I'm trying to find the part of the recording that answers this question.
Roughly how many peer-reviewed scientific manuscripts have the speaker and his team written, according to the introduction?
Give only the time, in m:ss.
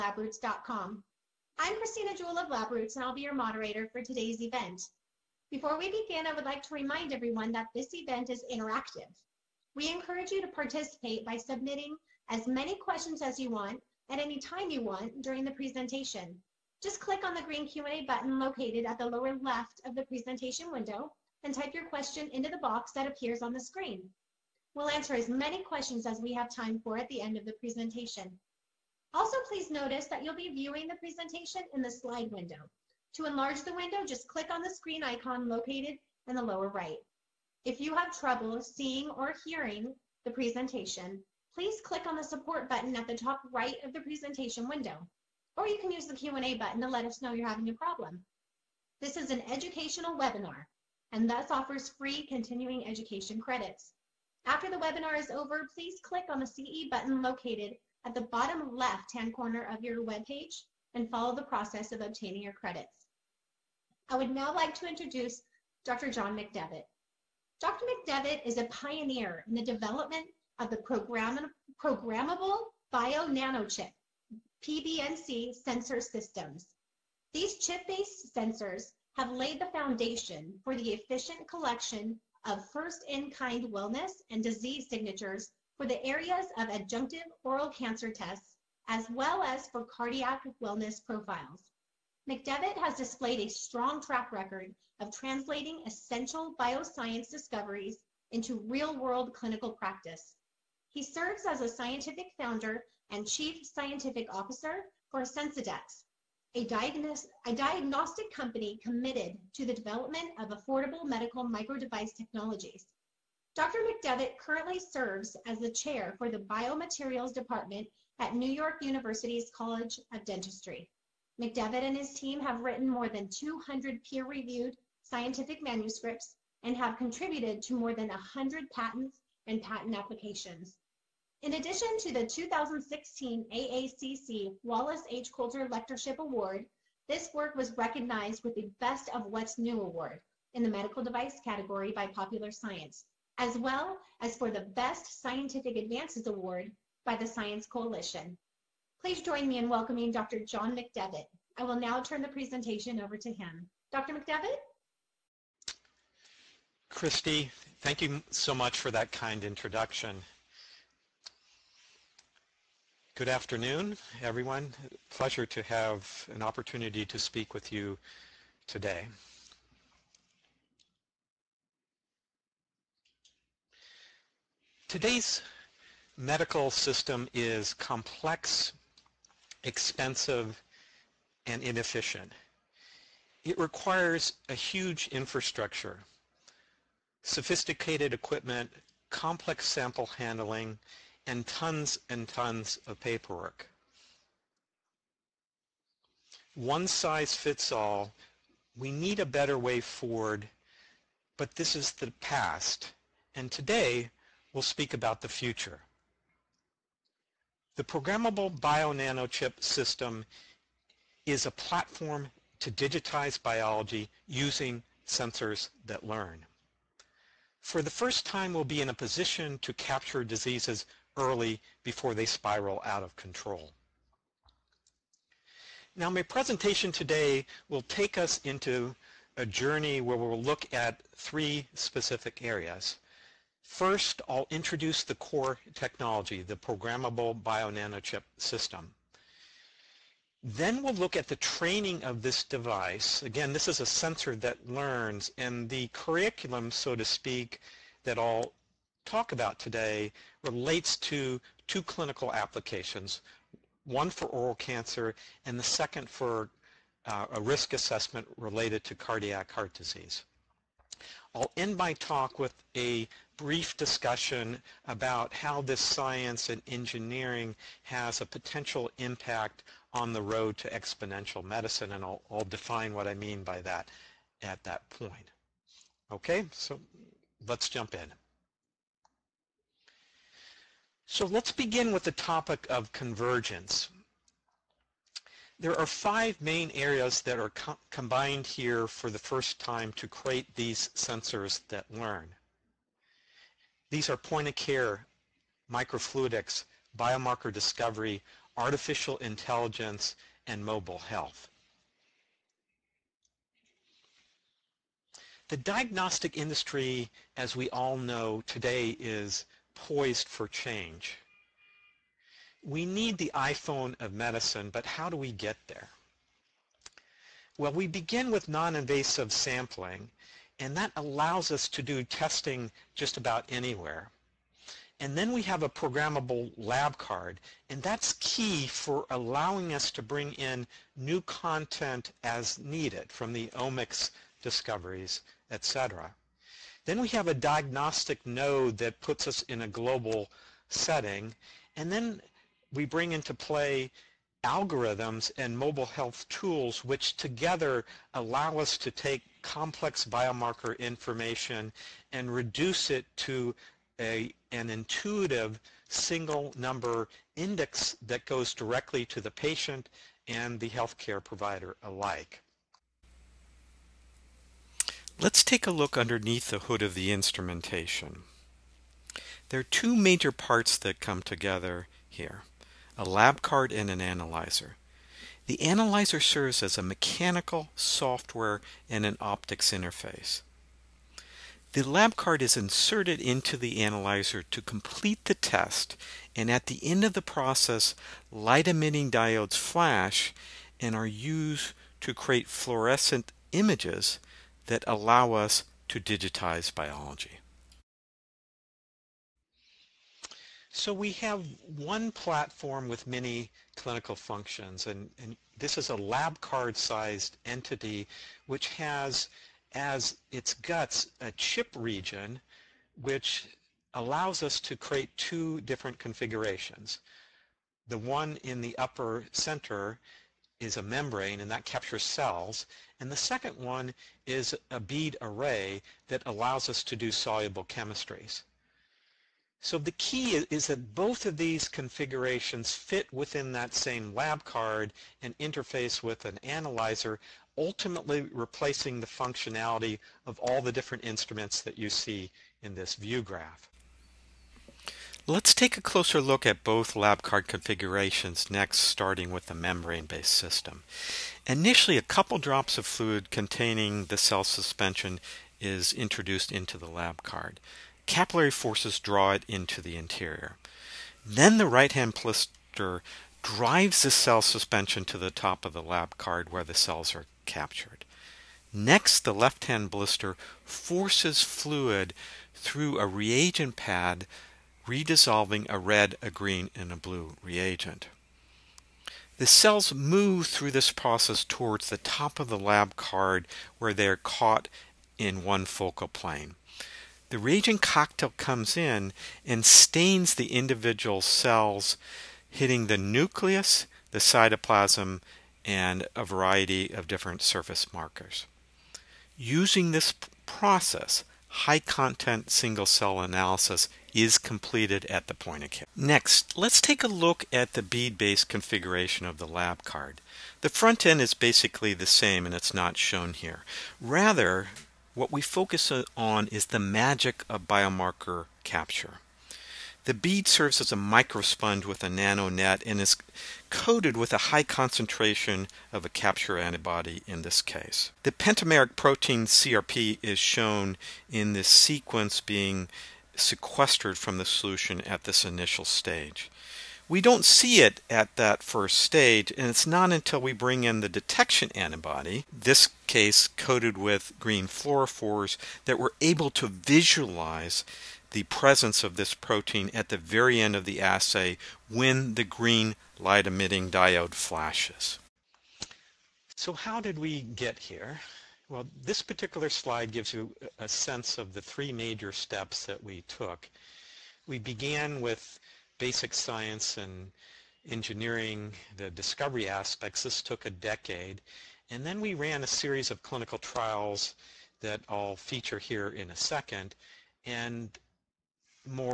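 2:02.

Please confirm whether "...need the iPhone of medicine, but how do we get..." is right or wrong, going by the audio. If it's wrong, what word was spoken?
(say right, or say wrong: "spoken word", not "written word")
right.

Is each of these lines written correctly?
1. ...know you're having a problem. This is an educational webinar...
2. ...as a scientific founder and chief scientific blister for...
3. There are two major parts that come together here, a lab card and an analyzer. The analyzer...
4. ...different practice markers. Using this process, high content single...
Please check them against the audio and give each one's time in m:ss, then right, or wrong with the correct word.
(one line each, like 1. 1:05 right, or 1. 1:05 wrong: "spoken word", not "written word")
1. 0:47 right
2. 1:41 wrong: "officer", not "blister"
3. 6:09 right
4. 8:17 wrong: "surface", not "practice".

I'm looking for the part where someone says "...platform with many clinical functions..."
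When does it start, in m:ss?
6:42.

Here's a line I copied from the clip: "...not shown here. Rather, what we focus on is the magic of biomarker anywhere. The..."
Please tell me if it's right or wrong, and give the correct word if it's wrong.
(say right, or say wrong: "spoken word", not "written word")
wrong: "capture", not "anywhere".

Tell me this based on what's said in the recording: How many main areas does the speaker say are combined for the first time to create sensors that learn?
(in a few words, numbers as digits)
5.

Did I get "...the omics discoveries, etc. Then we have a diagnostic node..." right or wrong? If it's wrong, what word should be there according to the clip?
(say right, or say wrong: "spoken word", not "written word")
right.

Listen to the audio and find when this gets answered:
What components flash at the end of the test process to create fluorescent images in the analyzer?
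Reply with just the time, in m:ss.
6:28.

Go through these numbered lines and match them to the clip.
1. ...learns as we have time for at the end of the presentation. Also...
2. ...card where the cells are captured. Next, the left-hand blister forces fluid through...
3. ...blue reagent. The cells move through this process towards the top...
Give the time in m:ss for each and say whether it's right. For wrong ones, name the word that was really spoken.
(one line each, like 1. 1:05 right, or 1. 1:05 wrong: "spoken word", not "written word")
1. 0:25 wrong: "questions", not "learns"
2. 7:46 right
3. 7:56 right.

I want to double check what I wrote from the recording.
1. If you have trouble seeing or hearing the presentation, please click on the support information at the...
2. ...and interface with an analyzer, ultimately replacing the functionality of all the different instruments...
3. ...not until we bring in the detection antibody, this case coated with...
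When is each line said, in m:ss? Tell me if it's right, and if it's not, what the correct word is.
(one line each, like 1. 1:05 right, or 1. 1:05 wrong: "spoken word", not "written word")
1. 0:37 wrong: "button", not "information"
2. 7:15 right
3. 8:59 right.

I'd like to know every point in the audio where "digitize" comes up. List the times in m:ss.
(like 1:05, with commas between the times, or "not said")
3:32, 6:35.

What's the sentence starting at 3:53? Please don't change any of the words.
First, I'll introduce the core technology, the programmable bio-nanochip system.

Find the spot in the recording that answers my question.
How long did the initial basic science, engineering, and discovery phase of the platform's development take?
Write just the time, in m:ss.
9:30.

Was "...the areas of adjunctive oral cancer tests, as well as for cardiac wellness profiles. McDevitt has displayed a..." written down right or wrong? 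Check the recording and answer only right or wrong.
right.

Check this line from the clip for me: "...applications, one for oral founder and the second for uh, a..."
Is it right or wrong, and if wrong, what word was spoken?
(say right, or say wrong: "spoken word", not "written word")
wrong: "cancer", not "founder".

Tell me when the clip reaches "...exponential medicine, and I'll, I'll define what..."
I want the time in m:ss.
4:30.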